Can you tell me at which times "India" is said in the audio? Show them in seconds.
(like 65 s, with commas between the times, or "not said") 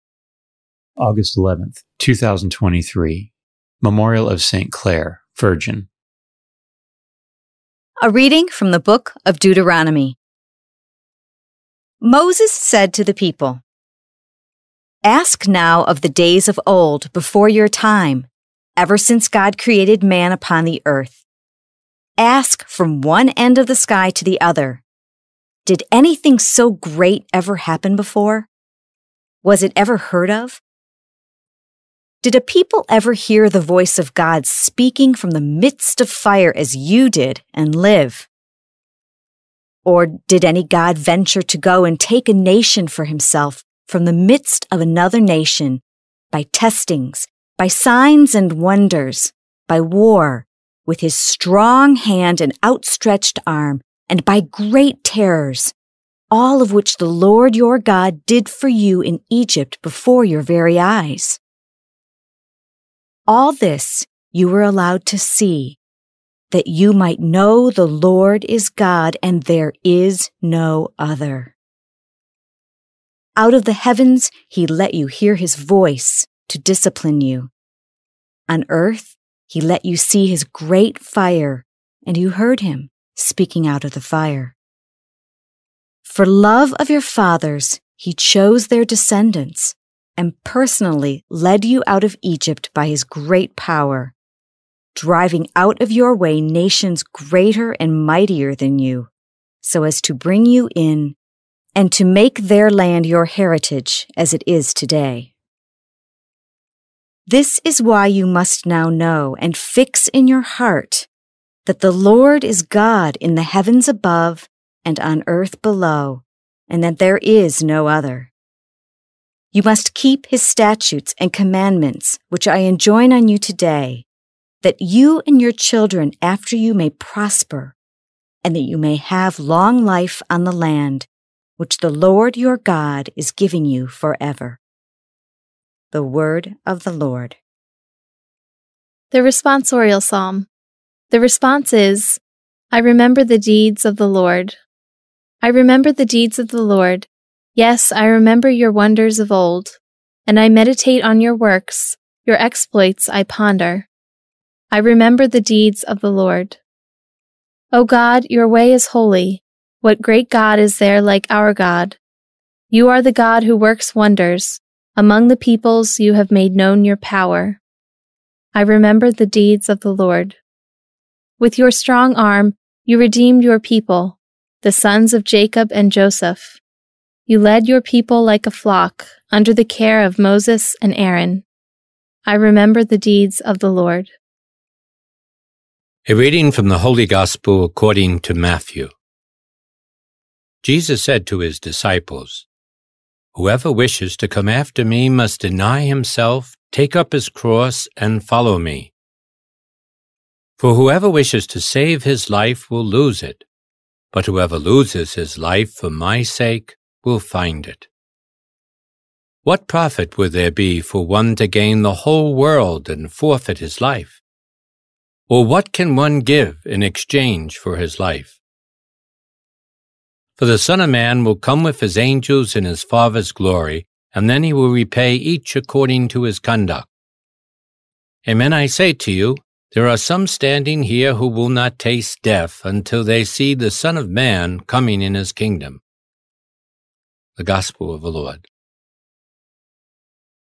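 not said.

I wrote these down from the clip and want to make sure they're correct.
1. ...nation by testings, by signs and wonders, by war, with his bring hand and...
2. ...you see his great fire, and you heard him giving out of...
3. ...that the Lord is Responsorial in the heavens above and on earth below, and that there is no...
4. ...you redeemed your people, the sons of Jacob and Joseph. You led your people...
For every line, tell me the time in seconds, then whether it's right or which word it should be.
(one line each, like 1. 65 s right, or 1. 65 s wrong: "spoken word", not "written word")
1. 45 s wrong: "strong", not "bring"
2. 79 s wrong: "speaking", not "giving"
3. 111 s wrong: "God", not "Responsorial"
4. 172 s right.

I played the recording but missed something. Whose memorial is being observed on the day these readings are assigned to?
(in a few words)
St. Clare.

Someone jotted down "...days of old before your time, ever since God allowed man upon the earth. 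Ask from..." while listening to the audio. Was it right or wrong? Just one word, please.
wrong.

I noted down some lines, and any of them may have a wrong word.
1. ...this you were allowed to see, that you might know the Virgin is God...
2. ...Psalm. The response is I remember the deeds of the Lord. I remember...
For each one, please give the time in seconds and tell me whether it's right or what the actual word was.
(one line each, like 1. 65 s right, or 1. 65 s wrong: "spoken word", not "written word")
1. 63 s wrong: "Lord", not "Virgin"
2. 140 s right.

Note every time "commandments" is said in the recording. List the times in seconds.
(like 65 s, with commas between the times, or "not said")
121 s.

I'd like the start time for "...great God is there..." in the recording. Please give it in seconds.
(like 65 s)
160 s.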